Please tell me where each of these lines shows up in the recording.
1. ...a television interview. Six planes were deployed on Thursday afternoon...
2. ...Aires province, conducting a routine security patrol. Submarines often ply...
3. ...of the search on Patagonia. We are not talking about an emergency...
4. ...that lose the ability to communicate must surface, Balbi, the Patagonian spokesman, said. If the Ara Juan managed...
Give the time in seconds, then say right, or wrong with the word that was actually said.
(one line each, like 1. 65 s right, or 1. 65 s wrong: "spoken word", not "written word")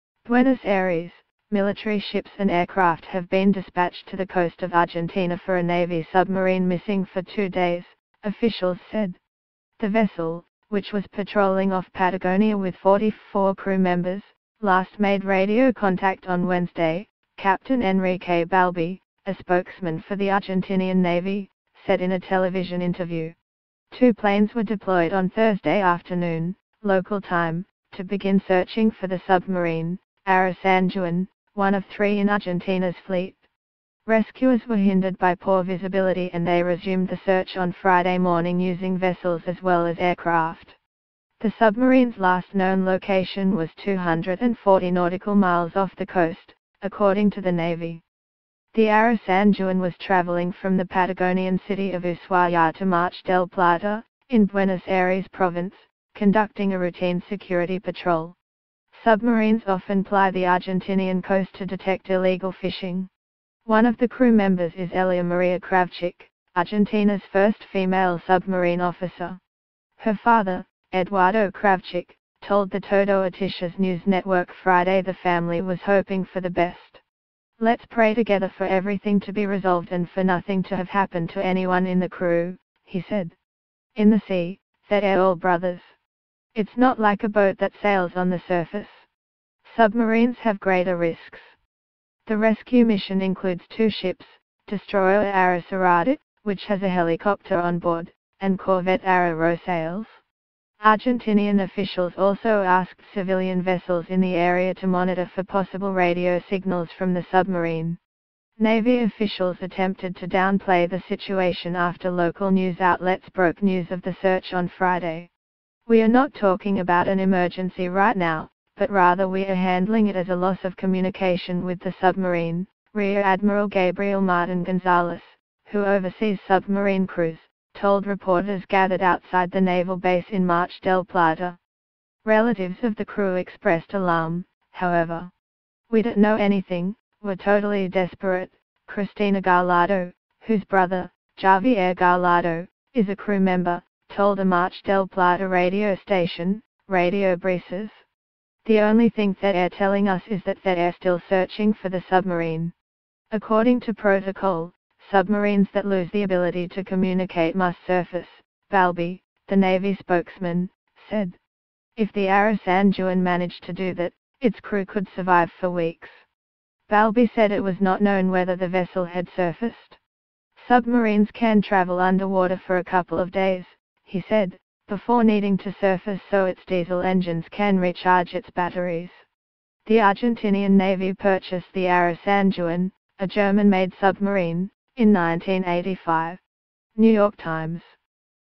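1. 22 s wrong: "Two", not "Six"
2. 54 s right
3. 113 s wrong: "Friday", not "Patagonia"
4. 155 s wrong: "Navy", not "Patagonian".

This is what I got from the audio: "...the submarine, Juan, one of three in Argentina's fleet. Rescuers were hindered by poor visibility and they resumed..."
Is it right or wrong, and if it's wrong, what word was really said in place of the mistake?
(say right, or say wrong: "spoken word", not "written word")
right.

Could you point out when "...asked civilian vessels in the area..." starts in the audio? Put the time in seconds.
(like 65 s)
102 s.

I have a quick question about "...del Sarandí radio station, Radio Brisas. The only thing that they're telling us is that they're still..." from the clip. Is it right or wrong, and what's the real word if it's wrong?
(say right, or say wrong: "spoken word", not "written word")
wrong: "Plata", not "Sarandí".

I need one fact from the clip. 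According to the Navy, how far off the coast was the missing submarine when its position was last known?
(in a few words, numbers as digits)
240 nautical miles.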